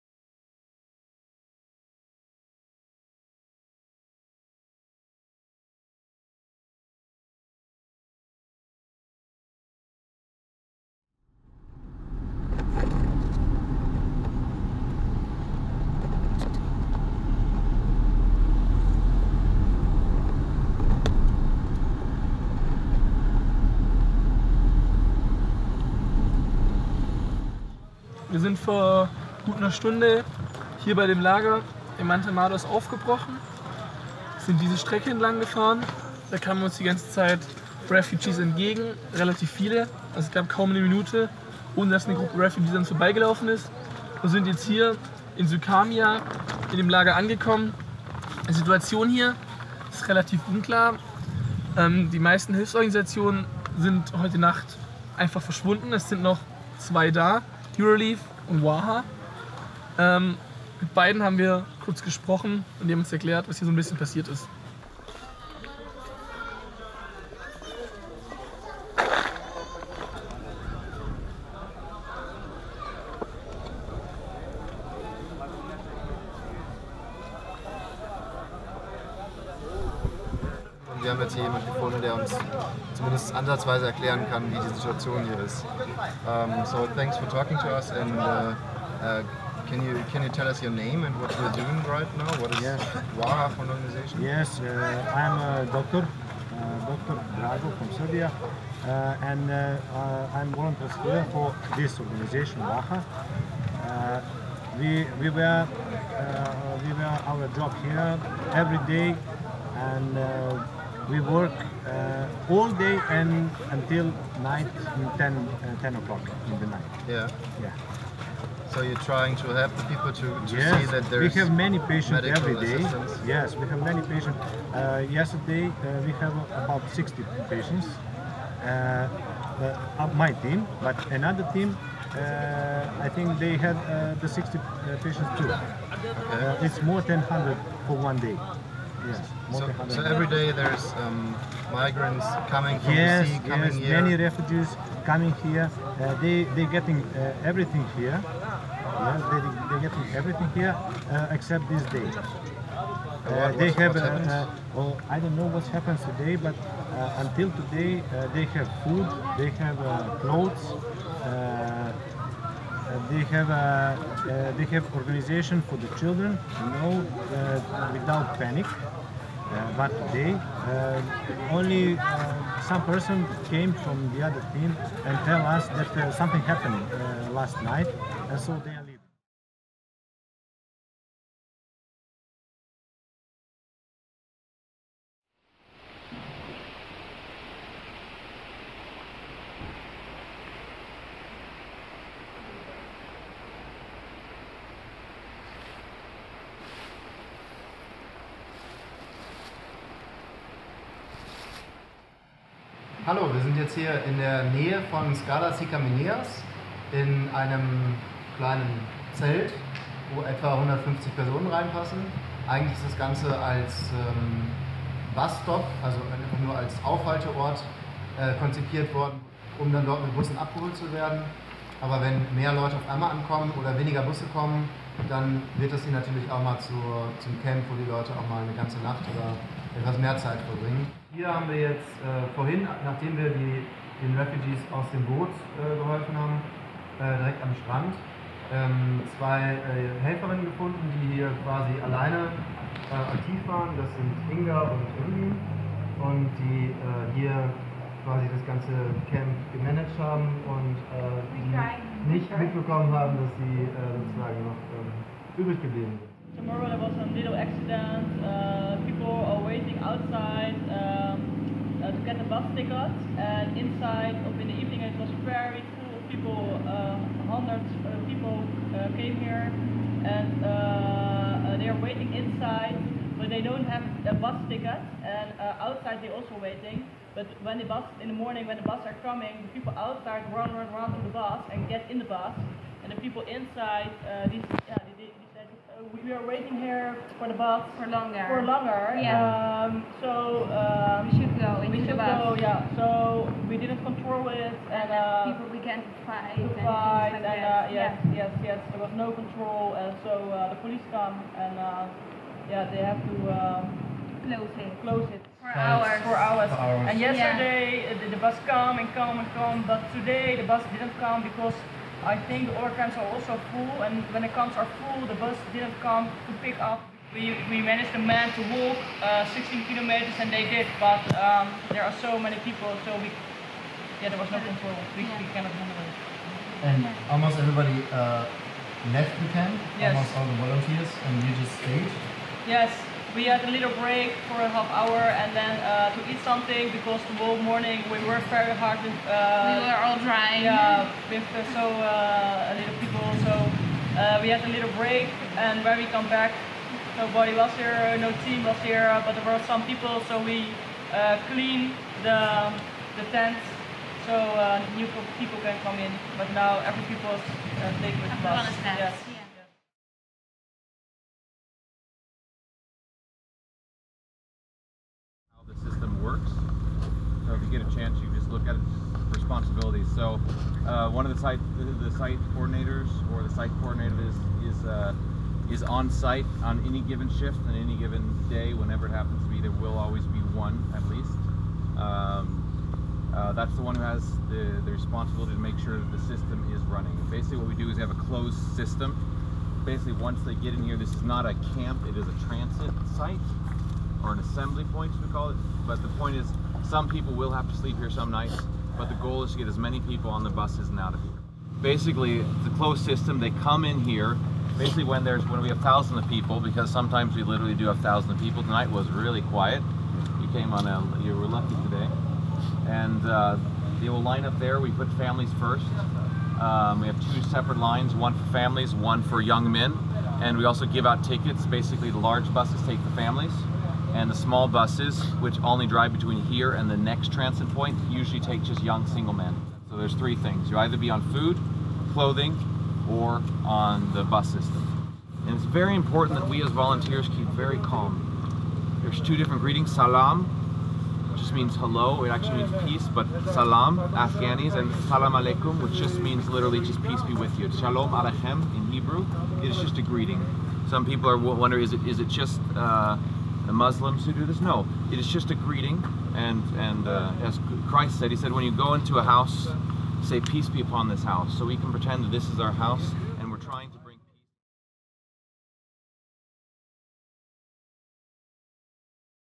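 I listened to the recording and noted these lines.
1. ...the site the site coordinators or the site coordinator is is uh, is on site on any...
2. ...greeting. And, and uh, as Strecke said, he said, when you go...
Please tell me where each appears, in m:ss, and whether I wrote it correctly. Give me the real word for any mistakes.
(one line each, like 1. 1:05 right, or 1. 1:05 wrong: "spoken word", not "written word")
1. 6:11 right
2. 7:35 wrong: "Christ", not "Strecke".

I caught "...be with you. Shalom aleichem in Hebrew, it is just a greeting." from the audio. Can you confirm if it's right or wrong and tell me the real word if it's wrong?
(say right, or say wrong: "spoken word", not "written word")
right.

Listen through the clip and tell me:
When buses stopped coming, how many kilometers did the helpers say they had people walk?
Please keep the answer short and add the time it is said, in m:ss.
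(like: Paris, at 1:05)
16, at 5:19.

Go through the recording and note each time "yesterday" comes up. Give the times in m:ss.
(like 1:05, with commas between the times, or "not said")
2:05, 5:06.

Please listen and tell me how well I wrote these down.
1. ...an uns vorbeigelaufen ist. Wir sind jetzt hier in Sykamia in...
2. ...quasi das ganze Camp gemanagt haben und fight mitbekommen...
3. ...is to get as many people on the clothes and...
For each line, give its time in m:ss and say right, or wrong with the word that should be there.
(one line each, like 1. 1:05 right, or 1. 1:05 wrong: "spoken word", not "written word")
1. 0:42 right
2. 4:08 wrong: "nicht", not "fight"
3. 6:39 wrong: "buses", not "clothes".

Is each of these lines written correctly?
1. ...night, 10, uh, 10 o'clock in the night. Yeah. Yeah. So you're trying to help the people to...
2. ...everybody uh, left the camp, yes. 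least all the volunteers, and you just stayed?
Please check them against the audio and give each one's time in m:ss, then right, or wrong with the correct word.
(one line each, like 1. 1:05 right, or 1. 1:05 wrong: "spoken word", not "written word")
1. 1:54 right
2. 5:27 wrong: "almost", not "least".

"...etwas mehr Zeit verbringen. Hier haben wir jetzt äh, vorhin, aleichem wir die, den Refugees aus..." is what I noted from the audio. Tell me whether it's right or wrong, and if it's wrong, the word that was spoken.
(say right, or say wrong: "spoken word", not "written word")
wrong: "nachdem", not "aleichem".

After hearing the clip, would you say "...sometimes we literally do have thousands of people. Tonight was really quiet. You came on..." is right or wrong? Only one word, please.
right.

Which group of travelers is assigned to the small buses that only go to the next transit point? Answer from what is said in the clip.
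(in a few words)
young single men.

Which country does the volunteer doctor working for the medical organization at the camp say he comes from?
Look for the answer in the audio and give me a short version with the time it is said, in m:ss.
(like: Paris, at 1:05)
Serbia, at 1:37.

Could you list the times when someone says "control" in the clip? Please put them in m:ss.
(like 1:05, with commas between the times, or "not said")
4:53, 4:59, 5:24.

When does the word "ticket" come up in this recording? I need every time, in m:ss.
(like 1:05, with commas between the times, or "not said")
4:22, 4:34, 7:01.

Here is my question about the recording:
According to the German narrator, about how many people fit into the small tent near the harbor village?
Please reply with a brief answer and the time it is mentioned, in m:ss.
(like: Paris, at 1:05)
150, at 3:30.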